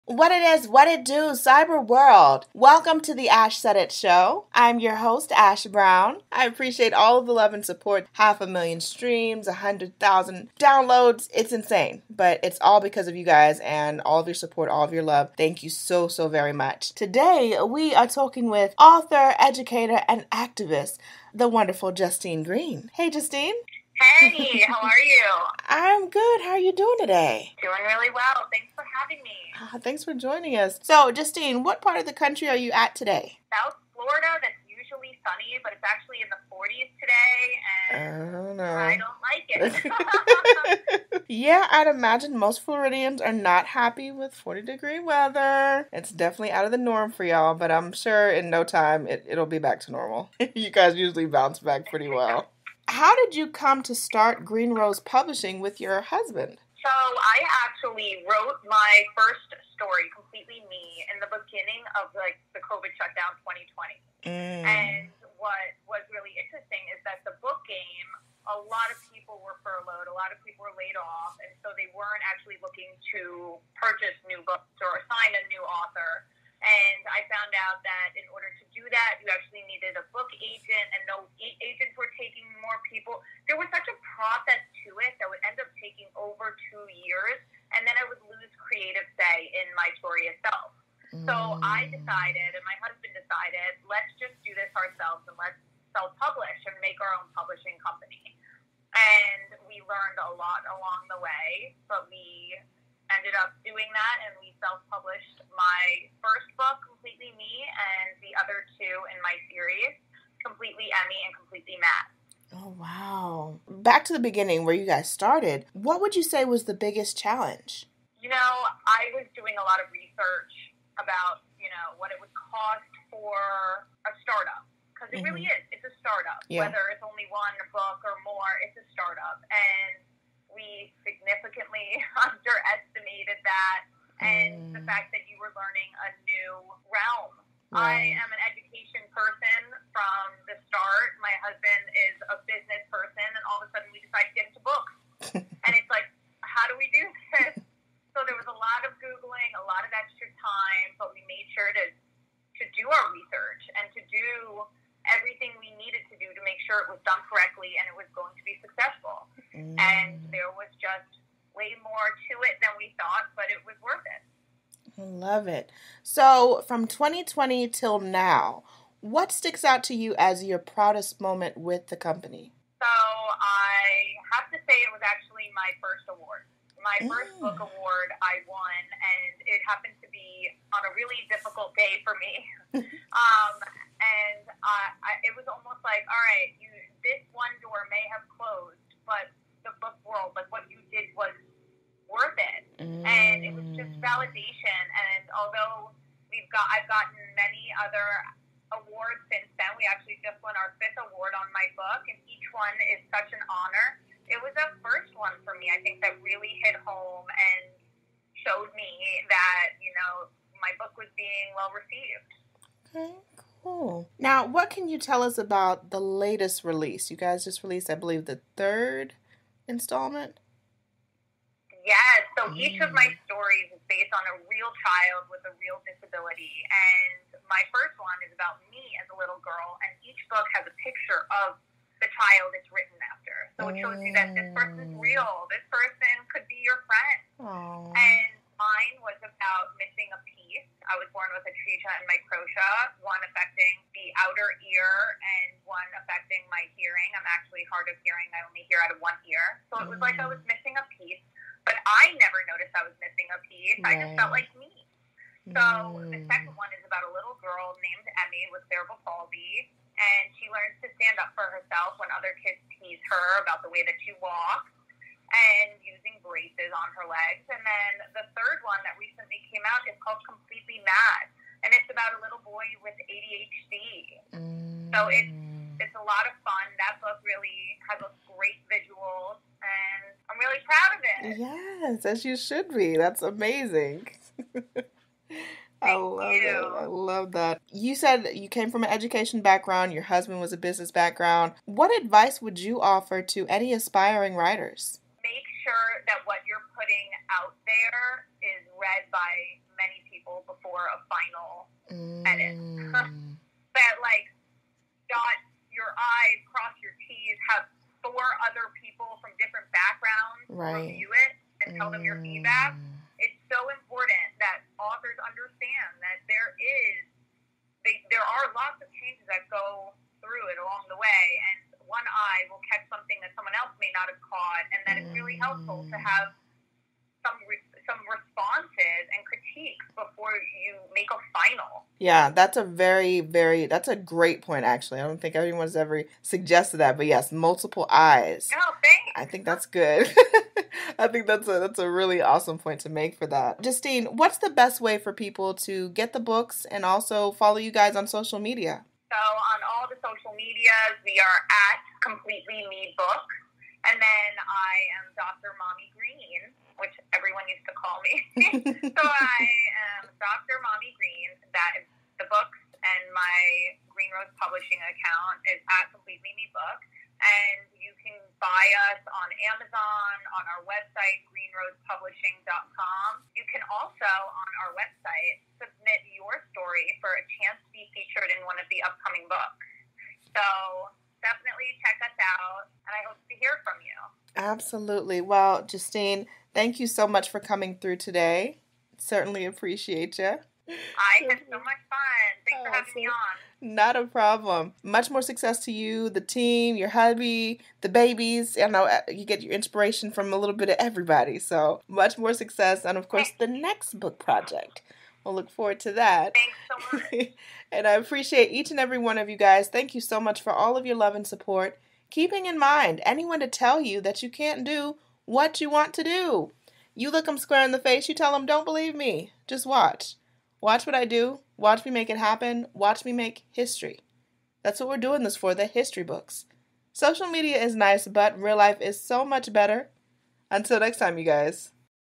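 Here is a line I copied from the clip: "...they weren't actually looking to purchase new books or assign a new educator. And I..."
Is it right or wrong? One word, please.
wrong.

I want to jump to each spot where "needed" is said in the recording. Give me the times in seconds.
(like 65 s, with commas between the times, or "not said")
79 s, 155 s.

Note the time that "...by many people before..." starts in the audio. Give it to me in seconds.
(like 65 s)
299 s.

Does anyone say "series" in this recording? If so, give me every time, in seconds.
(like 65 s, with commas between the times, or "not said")
109 s.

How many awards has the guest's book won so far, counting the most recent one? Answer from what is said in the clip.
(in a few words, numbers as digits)
5.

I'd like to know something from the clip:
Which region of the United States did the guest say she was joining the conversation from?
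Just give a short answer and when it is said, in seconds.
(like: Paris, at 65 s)
South Florida, at 33 s.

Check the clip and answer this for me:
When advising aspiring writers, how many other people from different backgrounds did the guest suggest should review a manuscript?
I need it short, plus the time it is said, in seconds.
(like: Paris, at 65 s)
4, at 308 s.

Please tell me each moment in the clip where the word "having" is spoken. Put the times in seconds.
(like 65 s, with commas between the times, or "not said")
29 s, 392 s.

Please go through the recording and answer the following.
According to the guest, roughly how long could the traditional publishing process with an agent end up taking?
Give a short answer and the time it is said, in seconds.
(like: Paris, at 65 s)
over two years, at 86 s.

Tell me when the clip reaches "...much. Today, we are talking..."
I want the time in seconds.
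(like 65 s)
16 s.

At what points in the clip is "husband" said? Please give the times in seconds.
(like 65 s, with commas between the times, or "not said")
56 s, 92 s, 141 s, 290 s.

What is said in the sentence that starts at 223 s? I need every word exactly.
stories is based on a real child with a real disability.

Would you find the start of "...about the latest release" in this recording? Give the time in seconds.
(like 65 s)
215 s.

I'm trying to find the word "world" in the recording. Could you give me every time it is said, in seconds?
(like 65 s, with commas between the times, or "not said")
1 s, 190 s.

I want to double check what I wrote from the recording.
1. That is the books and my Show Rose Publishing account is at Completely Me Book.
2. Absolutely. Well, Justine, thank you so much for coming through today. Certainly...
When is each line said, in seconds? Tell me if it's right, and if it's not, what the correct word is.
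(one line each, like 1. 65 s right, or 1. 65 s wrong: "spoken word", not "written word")
1. 361 s wrong: "Green", not "Show"
2. 384 s right.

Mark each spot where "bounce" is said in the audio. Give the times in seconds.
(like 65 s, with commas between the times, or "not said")
51 s.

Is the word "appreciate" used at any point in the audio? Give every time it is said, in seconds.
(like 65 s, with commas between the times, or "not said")
6 s, 389 s, 407 s.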